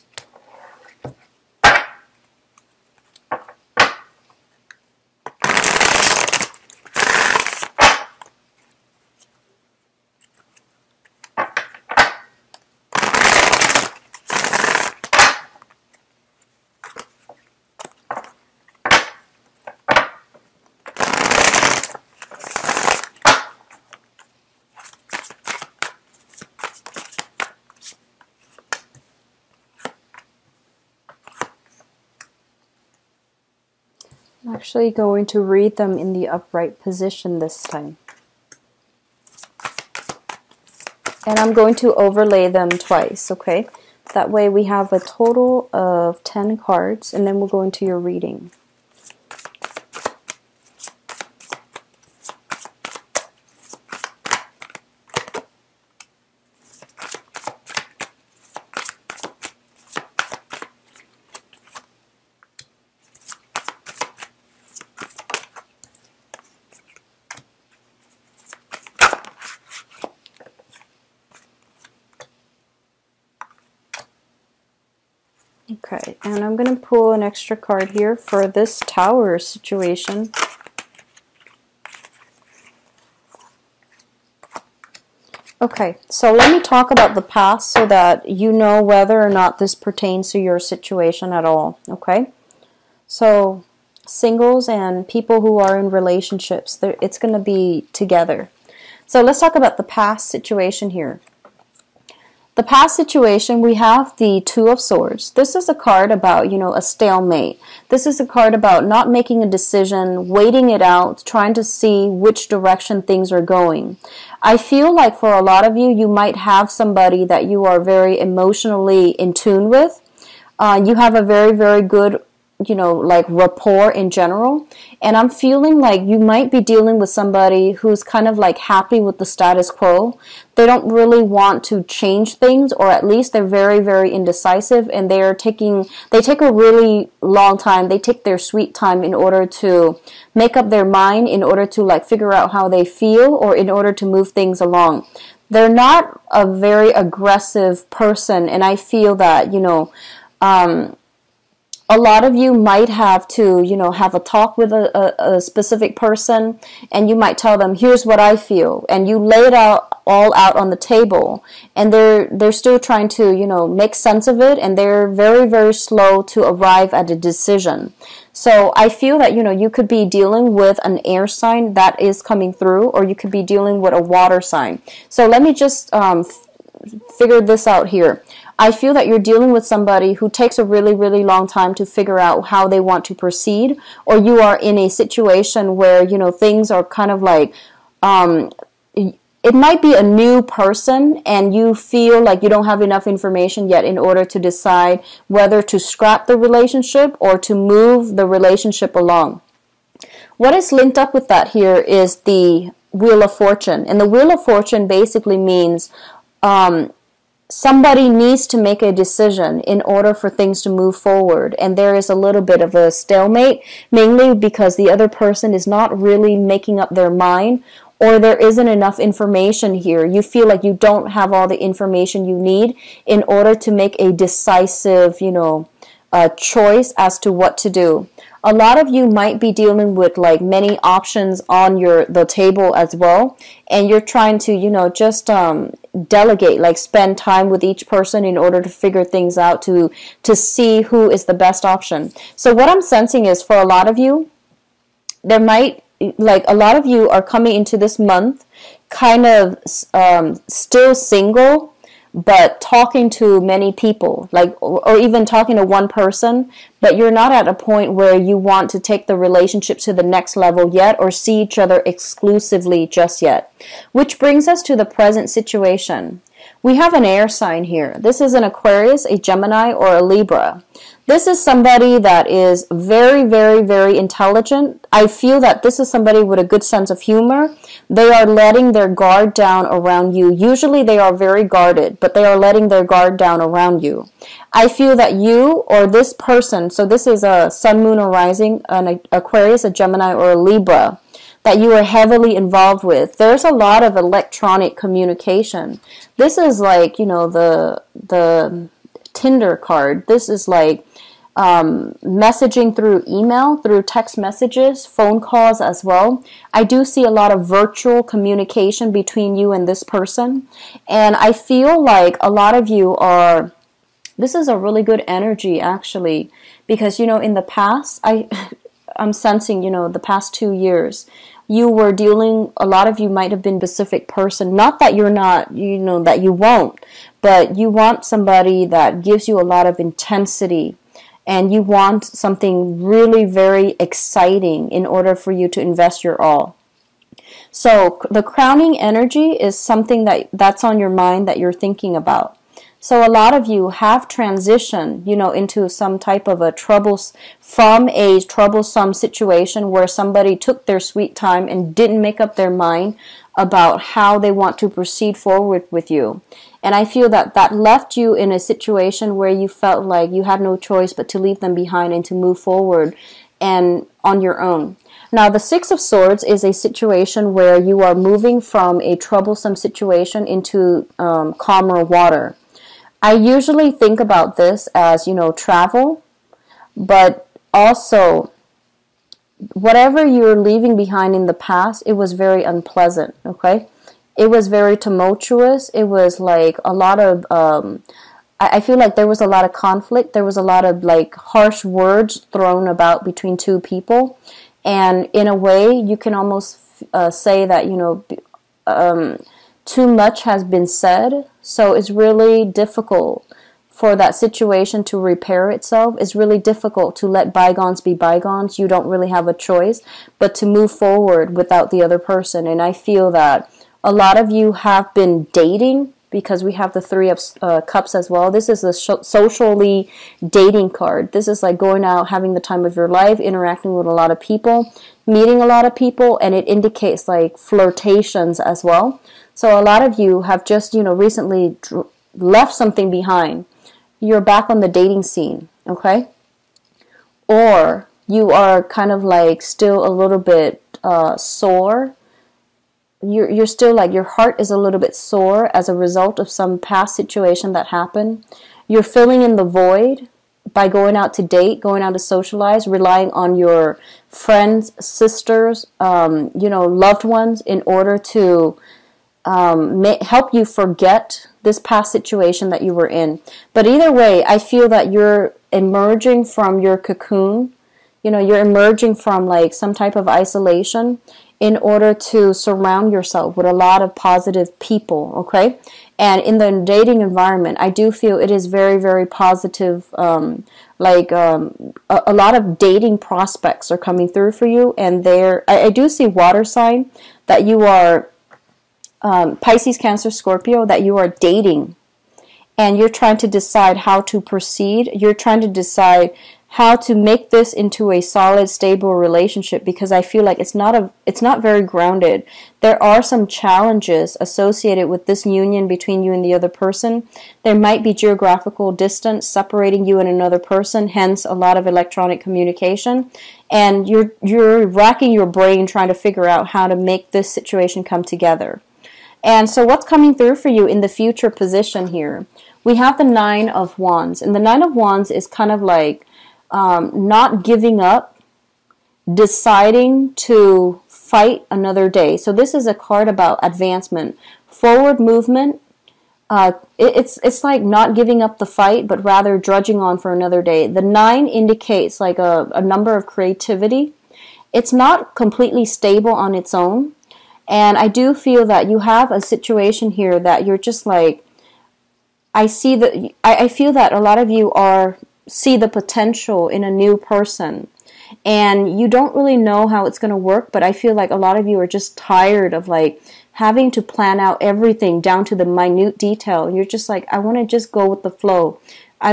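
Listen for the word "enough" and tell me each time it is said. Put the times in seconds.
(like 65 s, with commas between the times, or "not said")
192 s, 218 s.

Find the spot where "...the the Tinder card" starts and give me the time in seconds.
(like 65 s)
297 s.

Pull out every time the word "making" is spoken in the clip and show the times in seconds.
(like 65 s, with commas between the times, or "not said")
109 s, 216 s.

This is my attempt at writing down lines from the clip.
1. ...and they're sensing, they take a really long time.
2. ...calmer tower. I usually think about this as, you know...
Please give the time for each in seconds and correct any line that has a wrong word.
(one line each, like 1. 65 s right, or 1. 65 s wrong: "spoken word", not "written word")
1. 134 s wrong: "taking", not "sensing"
2. 371 s wrong: "water", not "tower".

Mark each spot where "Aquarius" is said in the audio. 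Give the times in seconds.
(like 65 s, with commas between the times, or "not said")
268 s, 289 s.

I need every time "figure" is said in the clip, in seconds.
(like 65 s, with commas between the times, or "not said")
142 s, 177 s, 181 s, 238 s, 515 s.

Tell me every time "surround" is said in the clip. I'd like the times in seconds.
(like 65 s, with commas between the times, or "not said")
472 s.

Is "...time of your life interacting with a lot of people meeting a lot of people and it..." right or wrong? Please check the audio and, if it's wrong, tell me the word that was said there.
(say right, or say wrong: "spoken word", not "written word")
right.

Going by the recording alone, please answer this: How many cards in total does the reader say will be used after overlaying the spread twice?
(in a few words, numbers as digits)
10.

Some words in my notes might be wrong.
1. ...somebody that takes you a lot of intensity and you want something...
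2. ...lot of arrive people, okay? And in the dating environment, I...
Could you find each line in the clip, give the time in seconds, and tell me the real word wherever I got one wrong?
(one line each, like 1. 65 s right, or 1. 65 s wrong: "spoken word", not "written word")
1. 328 s wrong: "gives", not "takes"
2. 473 s wrong: "positive", not "arrive".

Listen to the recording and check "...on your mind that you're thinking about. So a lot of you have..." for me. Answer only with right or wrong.
right.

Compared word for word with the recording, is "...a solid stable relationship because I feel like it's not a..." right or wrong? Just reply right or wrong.
right.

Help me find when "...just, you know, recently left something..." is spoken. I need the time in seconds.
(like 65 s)
430 s.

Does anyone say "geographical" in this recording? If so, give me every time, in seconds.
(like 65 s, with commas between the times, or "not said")
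507 s.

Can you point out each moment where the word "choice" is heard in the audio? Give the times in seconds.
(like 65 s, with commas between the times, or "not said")
226 s, 360 s, 409 s.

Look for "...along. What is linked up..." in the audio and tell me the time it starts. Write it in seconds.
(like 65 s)
198 s.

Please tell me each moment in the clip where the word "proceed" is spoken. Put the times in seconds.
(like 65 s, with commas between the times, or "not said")
183 s, 354 s, 494 s.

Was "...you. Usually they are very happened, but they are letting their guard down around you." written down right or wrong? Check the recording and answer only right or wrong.
wrong.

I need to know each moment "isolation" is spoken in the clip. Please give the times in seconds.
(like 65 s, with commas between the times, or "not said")
470 s.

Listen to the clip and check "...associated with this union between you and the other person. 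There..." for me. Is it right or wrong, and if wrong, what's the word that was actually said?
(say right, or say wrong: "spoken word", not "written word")
right.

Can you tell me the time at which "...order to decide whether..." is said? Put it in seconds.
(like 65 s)
193 s.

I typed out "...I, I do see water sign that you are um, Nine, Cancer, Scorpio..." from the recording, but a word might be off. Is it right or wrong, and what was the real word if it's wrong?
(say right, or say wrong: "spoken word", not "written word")
wrong: "Pisces", not "Nine".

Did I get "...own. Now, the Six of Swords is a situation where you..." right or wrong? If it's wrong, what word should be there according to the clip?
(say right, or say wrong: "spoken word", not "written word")
right.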